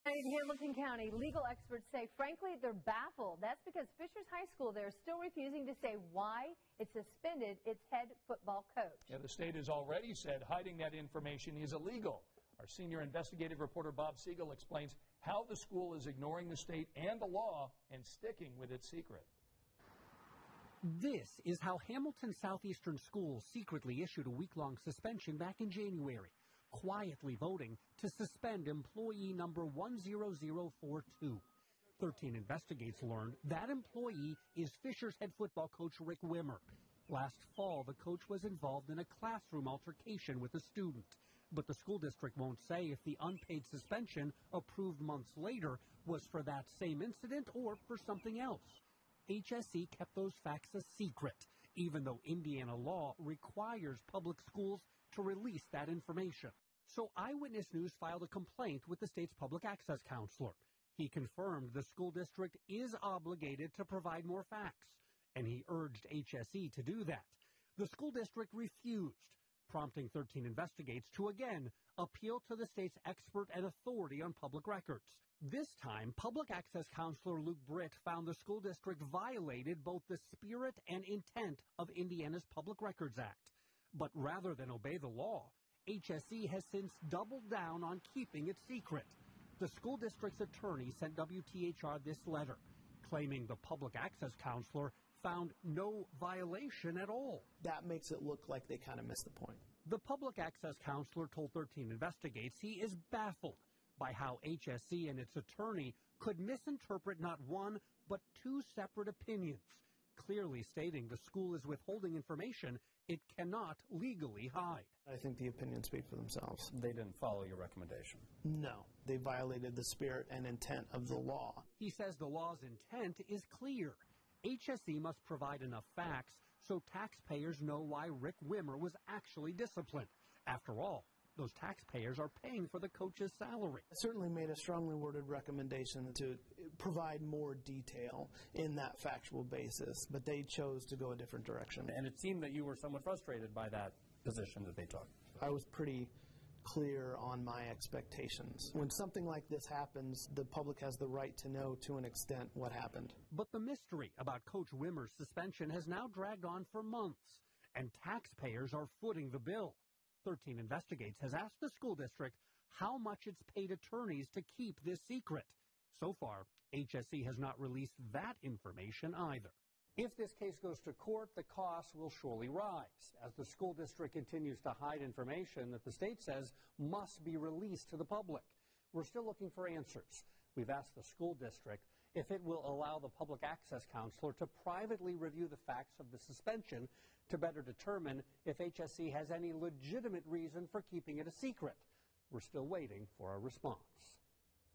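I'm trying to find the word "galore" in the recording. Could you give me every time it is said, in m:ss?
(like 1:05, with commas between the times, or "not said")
not said.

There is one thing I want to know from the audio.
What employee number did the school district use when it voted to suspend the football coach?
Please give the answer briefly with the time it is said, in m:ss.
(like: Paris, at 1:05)
10042, at 0:28.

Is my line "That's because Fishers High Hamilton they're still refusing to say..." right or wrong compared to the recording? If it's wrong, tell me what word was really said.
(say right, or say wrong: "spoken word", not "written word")
wrong: "School", not "Hamilton".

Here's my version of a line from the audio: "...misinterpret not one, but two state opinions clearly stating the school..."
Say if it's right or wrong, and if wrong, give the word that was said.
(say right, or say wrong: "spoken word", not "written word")
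wrong: "separate", not "state".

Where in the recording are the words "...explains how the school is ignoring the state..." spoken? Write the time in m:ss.
0:14.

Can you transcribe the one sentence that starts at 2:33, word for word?
But the mystery about Coach Wimmer's suspension has now dragged on for months, and taxpayers are footing the bill.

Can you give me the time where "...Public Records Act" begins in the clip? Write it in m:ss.
1:22.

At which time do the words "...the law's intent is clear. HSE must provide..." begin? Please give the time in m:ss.
2:02.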